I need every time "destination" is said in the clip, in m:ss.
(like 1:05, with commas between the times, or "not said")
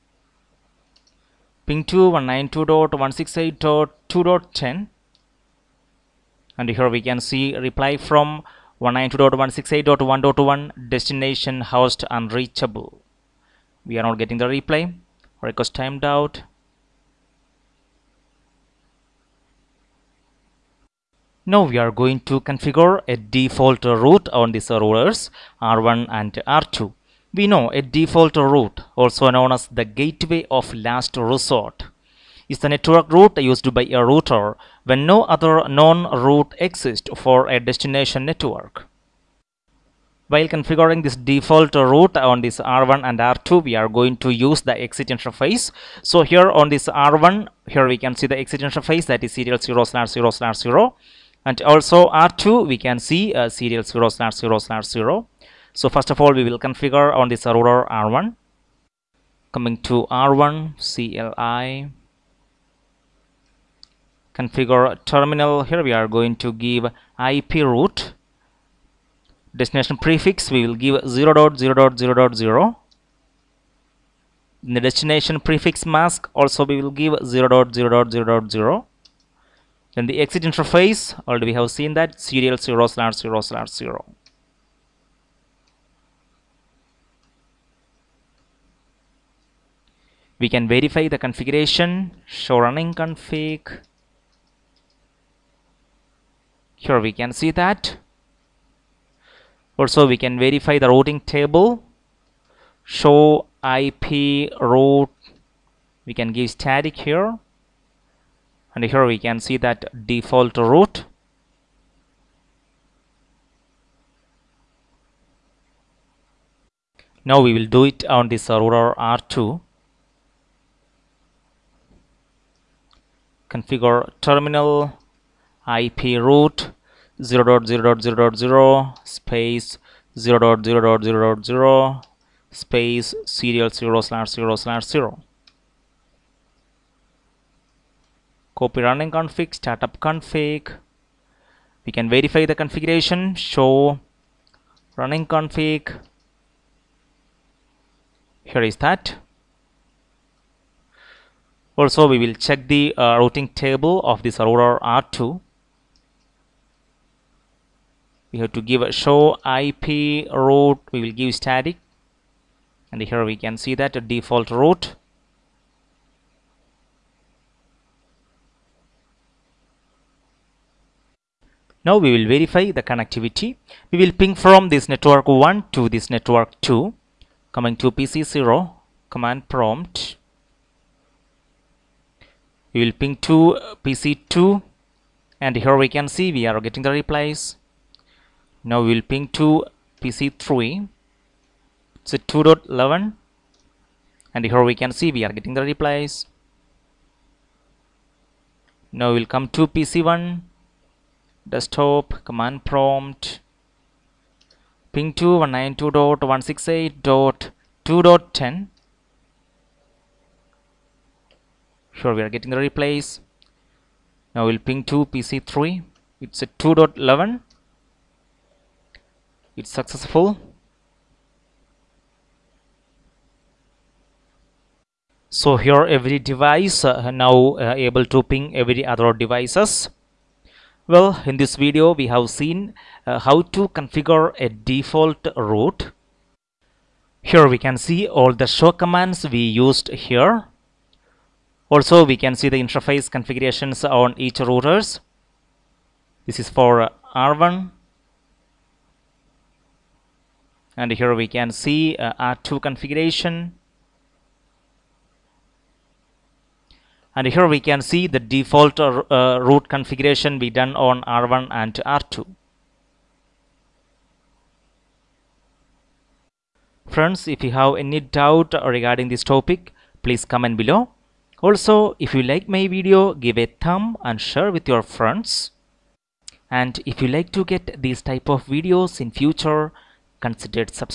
0:10, 0:37, 1:09, 1:14.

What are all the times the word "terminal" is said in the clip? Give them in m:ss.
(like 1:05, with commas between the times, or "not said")
1:05, 2:04.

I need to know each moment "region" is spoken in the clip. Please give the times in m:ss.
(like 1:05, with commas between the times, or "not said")
not said.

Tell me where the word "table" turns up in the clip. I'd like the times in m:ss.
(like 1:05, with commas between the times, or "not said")
1:41, 2:33.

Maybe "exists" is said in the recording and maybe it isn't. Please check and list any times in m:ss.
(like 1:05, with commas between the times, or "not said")
0:36.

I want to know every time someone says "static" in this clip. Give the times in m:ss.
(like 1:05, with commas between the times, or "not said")
1:46, 2:41.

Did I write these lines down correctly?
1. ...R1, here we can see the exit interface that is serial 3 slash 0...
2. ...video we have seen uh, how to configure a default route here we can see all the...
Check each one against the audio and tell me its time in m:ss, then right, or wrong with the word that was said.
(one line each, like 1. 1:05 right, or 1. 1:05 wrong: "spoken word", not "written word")
1. 0:46 wrong: "0", not "3"
2. 3:51 right.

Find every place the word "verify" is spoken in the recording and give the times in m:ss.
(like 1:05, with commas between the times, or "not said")
1:30, 1:40, 2:22, 2:52.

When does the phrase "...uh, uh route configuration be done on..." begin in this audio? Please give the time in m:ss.
4:18.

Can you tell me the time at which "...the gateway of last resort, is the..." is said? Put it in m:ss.
0:29.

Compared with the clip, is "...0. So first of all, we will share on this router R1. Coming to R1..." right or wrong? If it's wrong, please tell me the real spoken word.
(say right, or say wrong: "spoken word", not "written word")
wrong: "configure", not "share".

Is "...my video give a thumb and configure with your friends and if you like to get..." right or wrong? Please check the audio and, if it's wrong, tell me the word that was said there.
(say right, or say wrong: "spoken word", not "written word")
wrong: "share", not "configure".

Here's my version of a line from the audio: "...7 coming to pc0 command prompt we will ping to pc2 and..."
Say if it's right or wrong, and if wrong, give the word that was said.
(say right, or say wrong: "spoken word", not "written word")
wrong: "2", not "7".